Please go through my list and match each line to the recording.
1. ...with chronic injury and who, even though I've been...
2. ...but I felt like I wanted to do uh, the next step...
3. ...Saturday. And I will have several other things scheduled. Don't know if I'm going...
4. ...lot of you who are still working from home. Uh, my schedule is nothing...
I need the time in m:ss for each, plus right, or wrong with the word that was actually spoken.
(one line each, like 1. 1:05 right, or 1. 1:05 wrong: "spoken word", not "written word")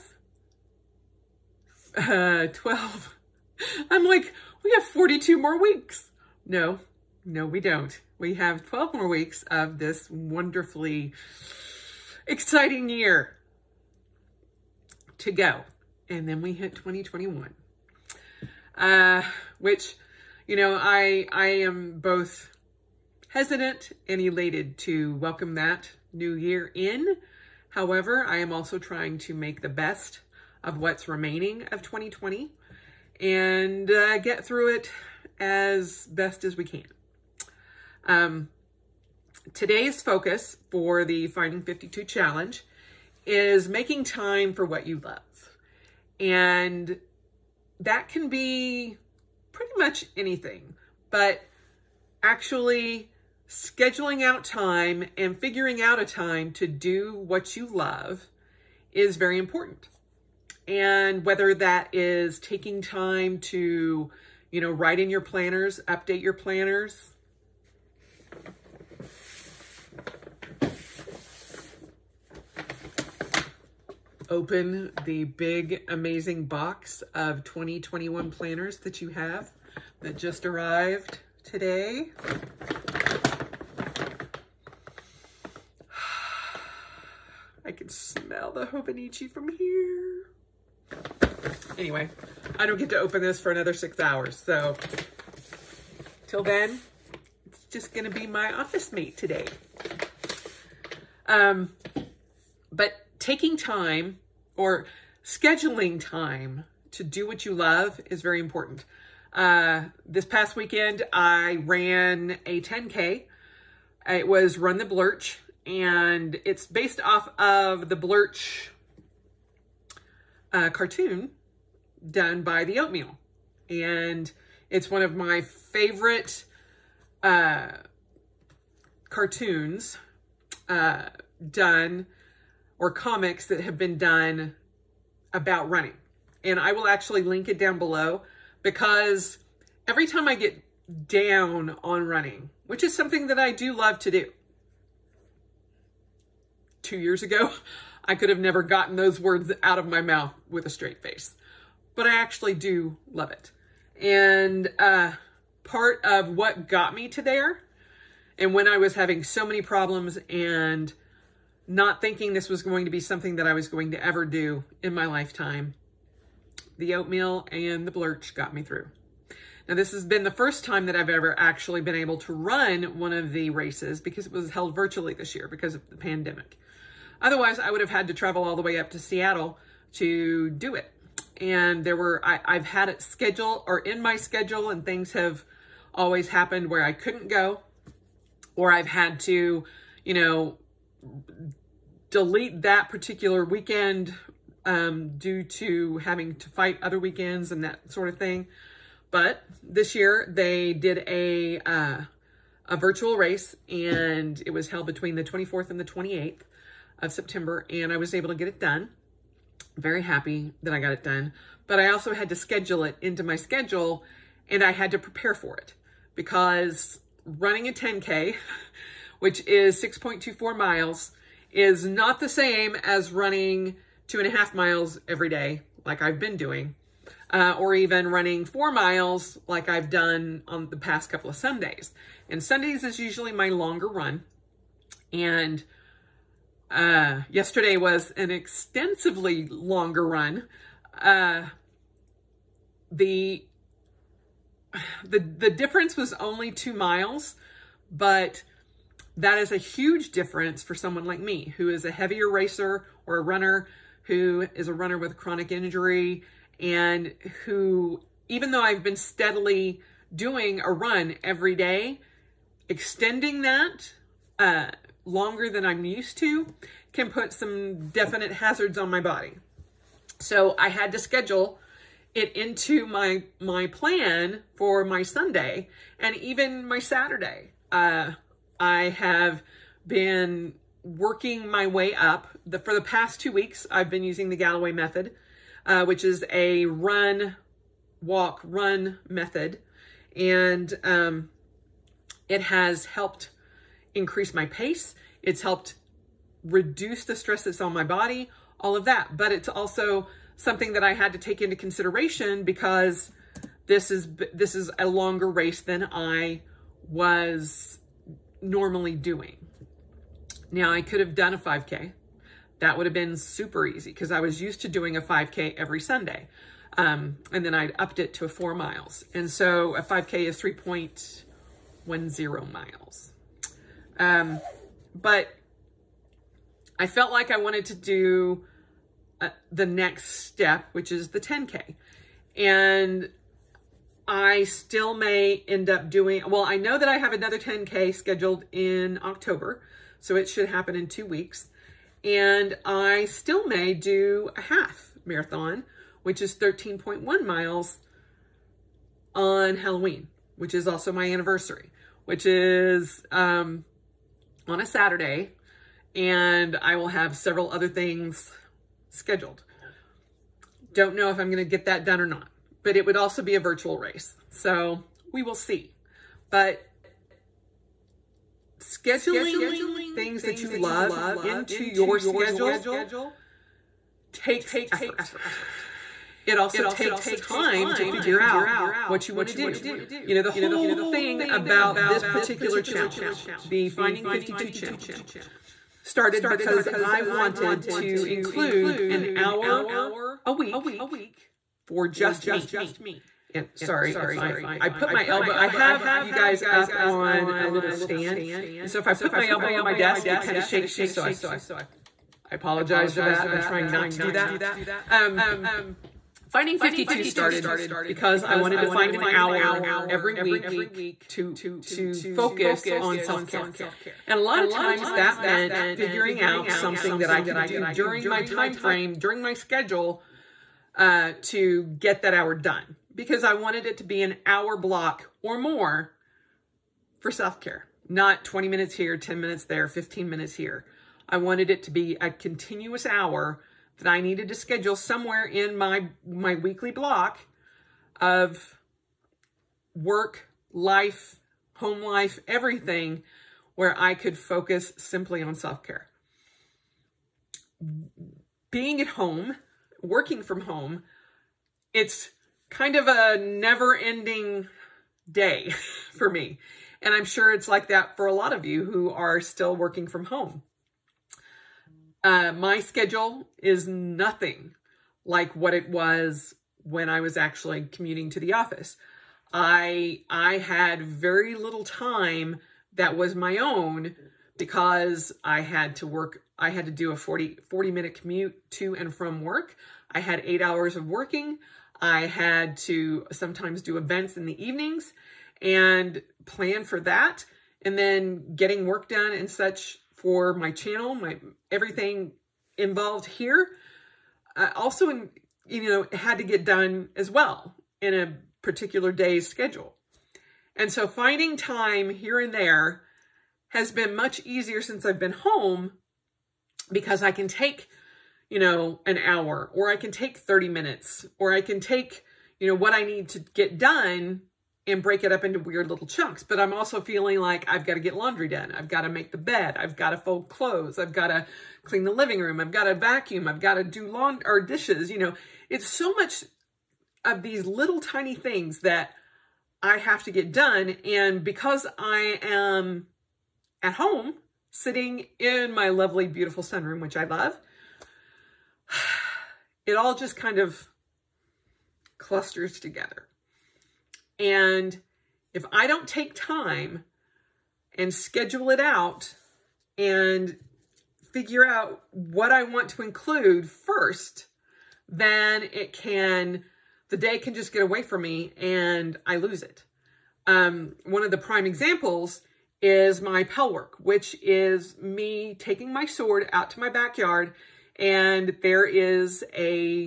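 1. 4:14 right
2. 5:24 right
3. 5:54 right
4. 7:38 right.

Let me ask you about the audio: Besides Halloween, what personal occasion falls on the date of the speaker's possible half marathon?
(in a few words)
anniversary.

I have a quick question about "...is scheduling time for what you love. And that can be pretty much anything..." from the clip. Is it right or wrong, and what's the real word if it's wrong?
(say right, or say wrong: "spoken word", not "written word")
wrong: "making", not "scheduling".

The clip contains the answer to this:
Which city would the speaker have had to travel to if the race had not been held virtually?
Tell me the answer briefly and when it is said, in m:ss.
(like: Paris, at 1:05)
Seattle, at 2:58.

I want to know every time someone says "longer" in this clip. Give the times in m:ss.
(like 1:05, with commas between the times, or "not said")
3:53, 3:59, 4:25, 5:04.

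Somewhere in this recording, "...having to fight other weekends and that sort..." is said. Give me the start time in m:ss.
3:15.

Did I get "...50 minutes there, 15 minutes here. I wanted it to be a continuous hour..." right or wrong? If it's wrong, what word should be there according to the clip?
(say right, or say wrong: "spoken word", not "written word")
wrong: "10", not "50".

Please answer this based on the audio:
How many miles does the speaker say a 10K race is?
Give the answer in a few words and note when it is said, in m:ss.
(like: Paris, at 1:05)
6.24 miles, at 3:39.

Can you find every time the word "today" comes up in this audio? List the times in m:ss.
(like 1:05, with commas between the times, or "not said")
0:39, 1:21, 1:39.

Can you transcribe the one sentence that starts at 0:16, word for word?
And then we hit 2021 uh, which, you know, I, I am both hesitant and elated to welcome that new year in.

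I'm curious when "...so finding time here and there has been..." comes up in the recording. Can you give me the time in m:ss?
8:20.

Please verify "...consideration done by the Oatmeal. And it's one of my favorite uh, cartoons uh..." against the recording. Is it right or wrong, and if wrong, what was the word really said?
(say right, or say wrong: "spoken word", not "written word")
wrong: "cartoon", not "consideration".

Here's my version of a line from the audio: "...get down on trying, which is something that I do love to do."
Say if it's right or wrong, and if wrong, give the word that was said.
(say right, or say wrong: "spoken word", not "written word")
wrong: "running", not "trying".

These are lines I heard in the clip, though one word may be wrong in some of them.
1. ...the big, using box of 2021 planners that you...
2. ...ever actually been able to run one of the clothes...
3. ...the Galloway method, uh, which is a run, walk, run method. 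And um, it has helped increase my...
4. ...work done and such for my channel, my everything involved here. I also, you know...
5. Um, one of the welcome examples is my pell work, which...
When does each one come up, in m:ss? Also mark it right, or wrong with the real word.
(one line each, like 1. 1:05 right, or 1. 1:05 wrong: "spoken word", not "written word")
1. 1:15 wrong: "amazing", not "using"
2. 2:51 wrong: "races", not "clothes"
3. 4:44 right
4. 8:08 right
5. 9:20 wrong: "prime", not "welcome".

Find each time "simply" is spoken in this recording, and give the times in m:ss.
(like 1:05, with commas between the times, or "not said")
7:24.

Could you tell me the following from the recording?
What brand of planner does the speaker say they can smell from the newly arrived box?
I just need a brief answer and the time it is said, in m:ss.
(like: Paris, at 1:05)
Hobonichi, at 1:28.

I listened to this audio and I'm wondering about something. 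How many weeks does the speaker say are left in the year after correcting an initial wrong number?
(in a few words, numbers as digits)
12.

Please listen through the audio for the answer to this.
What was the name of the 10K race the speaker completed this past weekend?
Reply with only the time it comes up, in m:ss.
1:54.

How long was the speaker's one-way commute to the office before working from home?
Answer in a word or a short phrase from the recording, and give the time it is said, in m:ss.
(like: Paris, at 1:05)
40 minutes, at 7:57.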